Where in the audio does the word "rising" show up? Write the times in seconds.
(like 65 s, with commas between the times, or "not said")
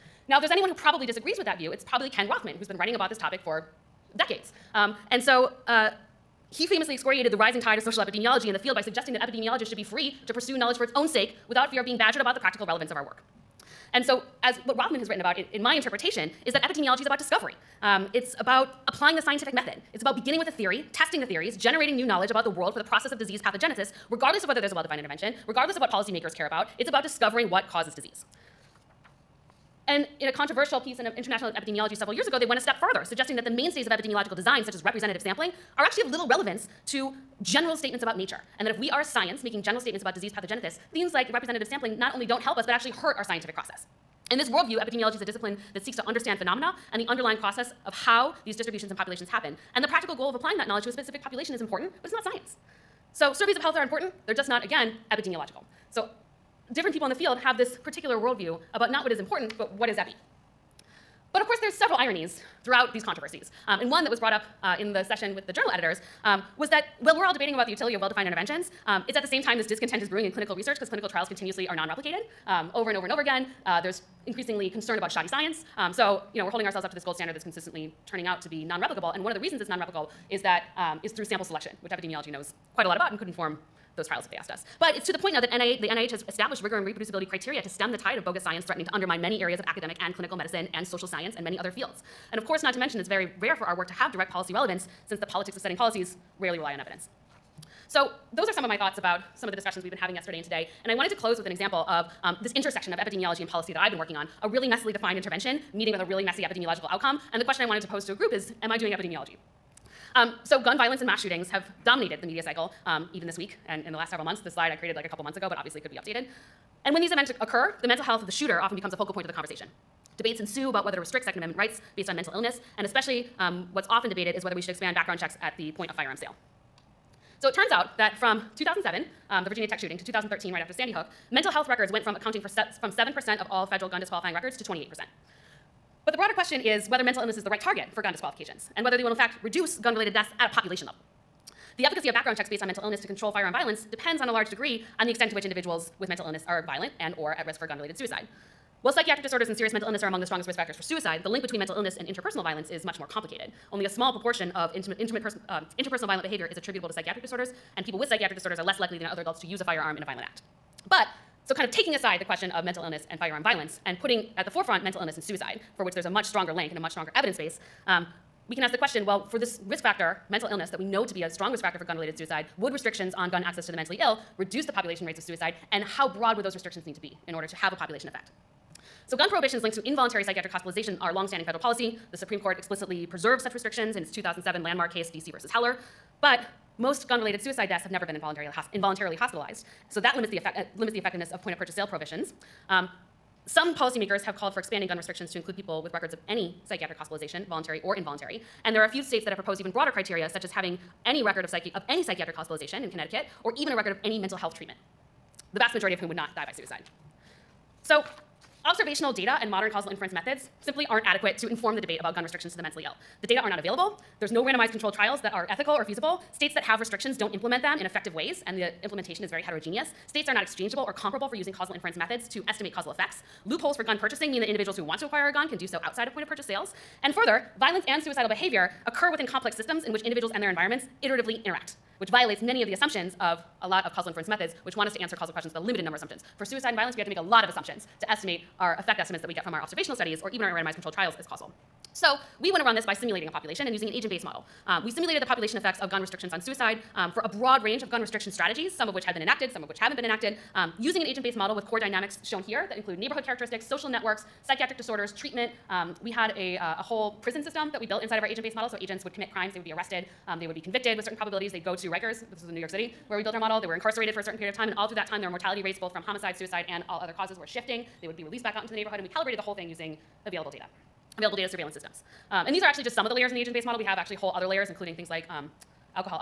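7 s.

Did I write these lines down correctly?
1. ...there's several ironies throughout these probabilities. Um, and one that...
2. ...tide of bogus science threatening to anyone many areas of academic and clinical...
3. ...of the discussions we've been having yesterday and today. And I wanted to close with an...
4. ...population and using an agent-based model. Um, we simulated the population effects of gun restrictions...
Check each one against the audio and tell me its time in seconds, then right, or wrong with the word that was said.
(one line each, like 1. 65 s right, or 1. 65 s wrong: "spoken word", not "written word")
1. 61 s wrong: "controversies", not "probabilities"
2. 87 s wrong: "undermine", not "anyone"
3. 99 s right
4. 243 s right.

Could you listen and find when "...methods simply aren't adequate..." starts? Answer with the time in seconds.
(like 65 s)
210 s.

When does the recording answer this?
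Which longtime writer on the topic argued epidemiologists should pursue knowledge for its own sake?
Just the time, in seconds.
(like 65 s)
2 s.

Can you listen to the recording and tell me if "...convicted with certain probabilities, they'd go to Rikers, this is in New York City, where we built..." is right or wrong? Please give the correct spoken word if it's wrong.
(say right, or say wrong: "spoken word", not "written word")
right.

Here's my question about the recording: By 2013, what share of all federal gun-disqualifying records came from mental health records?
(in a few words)
28%.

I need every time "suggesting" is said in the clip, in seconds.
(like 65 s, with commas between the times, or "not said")
8 s, 33 s.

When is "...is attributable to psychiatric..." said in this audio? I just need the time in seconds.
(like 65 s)
156 s.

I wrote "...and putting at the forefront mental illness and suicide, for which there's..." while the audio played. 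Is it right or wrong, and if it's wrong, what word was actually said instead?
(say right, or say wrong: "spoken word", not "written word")
right.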